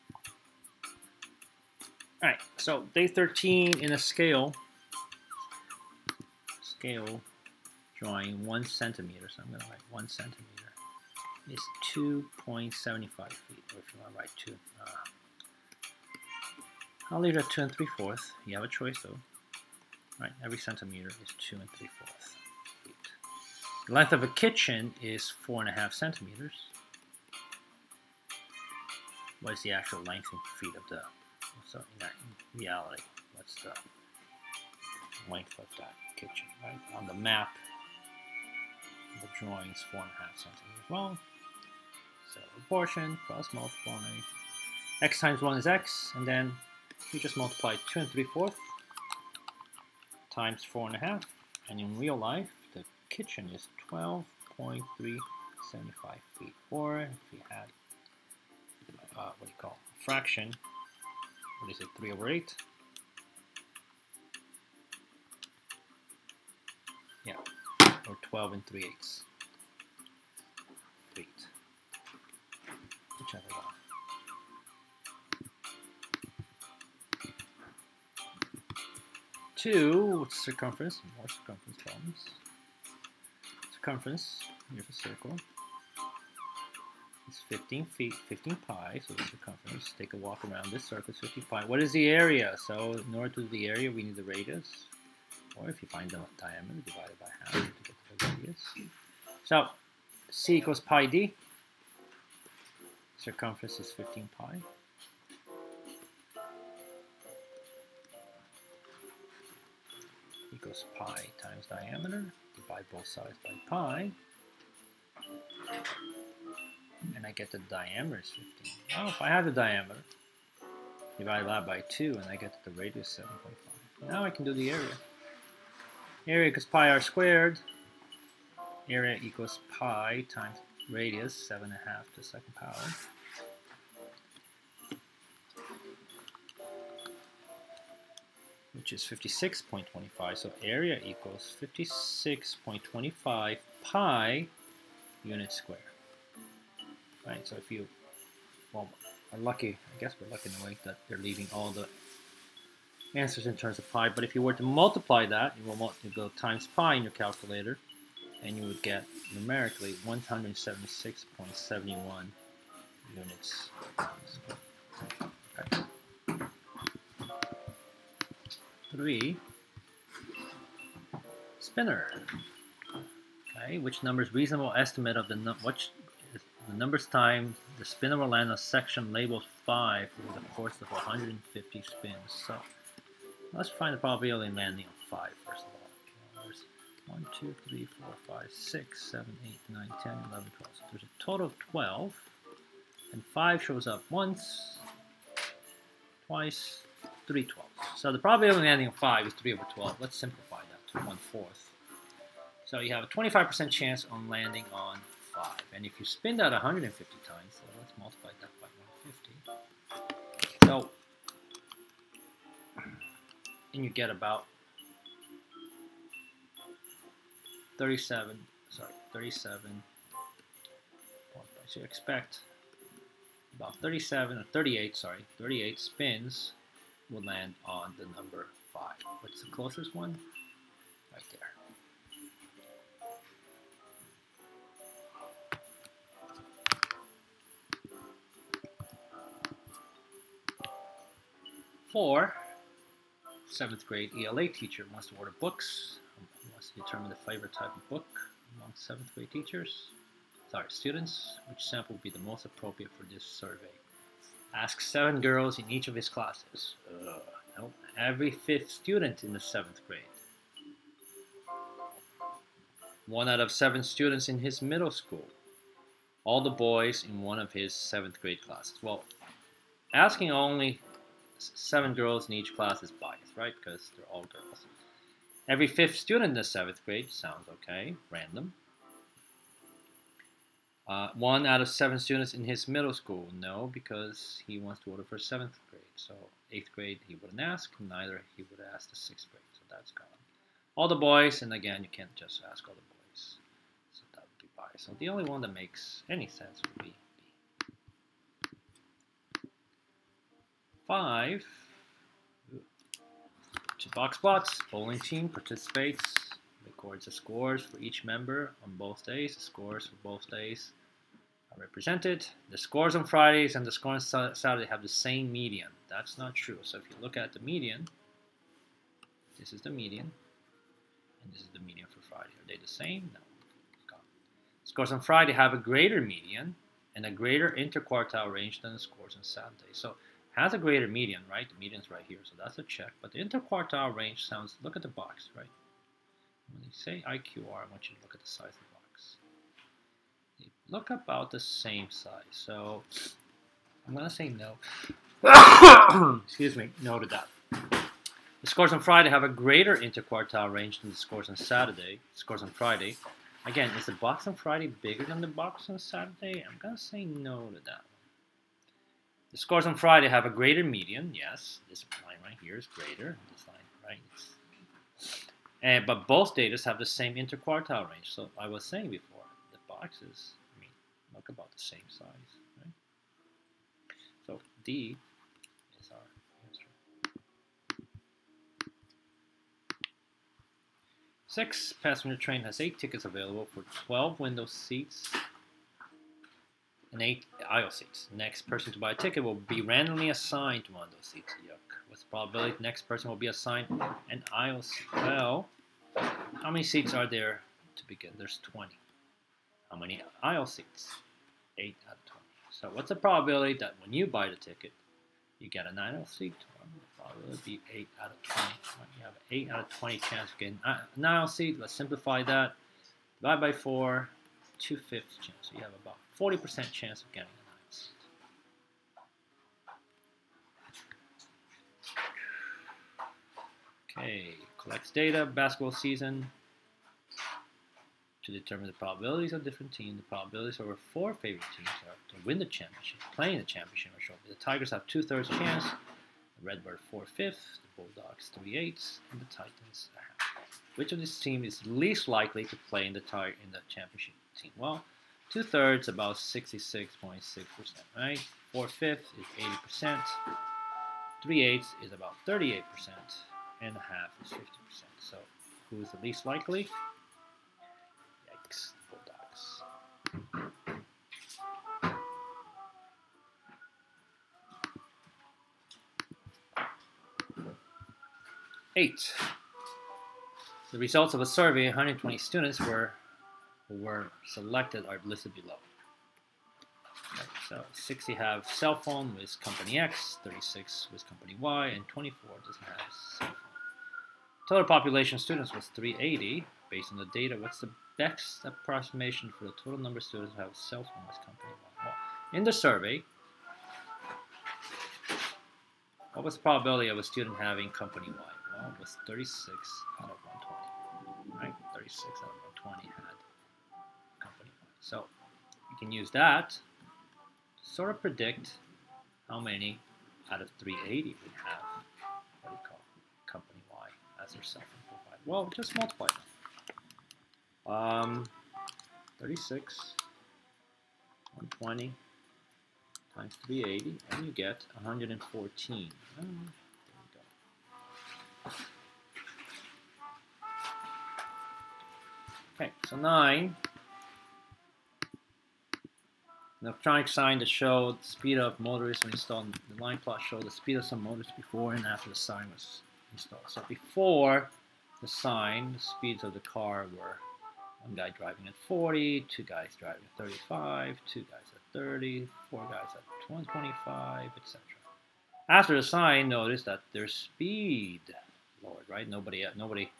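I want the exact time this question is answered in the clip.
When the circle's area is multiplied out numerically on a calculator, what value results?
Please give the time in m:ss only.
2:40.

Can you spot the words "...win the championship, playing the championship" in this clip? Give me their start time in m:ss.
7:12.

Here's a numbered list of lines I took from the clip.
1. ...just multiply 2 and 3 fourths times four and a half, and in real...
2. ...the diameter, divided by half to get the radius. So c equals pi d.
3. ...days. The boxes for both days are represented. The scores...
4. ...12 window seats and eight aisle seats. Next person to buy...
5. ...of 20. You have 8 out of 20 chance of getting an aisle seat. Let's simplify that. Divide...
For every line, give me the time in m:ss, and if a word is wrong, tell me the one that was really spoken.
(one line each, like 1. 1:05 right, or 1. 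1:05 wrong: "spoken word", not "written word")
1. 0:47 right
2. 1:36 right
3. 5:09 wrong: "scores", not "boxes"
4. 6:23 right
5. 6:48 right.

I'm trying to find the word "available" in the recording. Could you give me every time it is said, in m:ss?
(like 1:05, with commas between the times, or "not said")
6:23.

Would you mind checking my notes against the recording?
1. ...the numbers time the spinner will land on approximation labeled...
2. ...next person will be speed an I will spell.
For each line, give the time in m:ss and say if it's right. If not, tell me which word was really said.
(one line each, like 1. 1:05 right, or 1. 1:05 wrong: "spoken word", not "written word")
1. 2:56 wrong: "section", not "approximation"
2. 6:32 wrong: "assigned", not "speed".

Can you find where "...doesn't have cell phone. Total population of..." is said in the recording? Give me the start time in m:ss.
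8:02.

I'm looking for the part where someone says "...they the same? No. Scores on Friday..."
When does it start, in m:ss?
5:22.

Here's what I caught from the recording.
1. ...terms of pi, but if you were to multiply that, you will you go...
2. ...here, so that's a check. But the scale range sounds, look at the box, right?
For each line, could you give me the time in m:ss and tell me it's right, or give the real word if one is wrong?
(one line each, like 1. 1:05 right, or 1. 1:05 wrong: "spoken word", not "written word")
1. 2:33 right
2. 5:32 wrong: "interquartile", not "scale".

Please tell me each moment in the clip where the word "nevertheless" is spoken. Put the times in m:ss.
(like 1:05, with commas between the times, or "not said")
not said.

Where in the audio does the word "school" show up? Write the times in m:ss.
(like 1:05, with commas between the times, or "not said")
4:24, 4:42.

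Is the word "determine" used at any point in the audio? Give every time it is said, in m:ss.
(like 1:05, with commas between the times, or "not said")
4:06, 7:08.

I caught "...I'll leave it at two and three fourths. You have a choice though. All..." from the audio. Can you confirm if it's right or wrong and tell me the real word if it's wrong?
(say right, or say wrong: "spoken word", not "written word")
right.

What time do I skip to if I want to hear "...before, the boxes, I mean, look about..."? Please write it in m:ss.
6:08.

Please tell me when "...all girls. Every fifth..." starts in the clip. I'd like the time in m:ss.
4:34.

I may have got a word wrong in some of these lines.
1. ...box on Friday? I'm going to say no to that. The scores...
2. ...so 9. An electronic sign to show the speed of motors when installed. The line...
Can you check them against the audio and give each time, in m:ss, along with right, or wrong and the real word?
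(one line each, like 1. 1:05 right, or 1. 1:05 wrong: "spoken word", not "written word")
1. 5:55 wrong: "Saturday", not "Friday"
2. 8:52 right.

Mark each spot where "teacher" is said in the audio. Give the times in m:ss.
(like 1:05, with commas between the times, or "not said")
4:04, 4:09.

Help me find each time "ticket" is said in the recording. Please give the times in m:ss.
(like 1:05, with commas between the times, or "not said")
6:22, 6:28, 6:44.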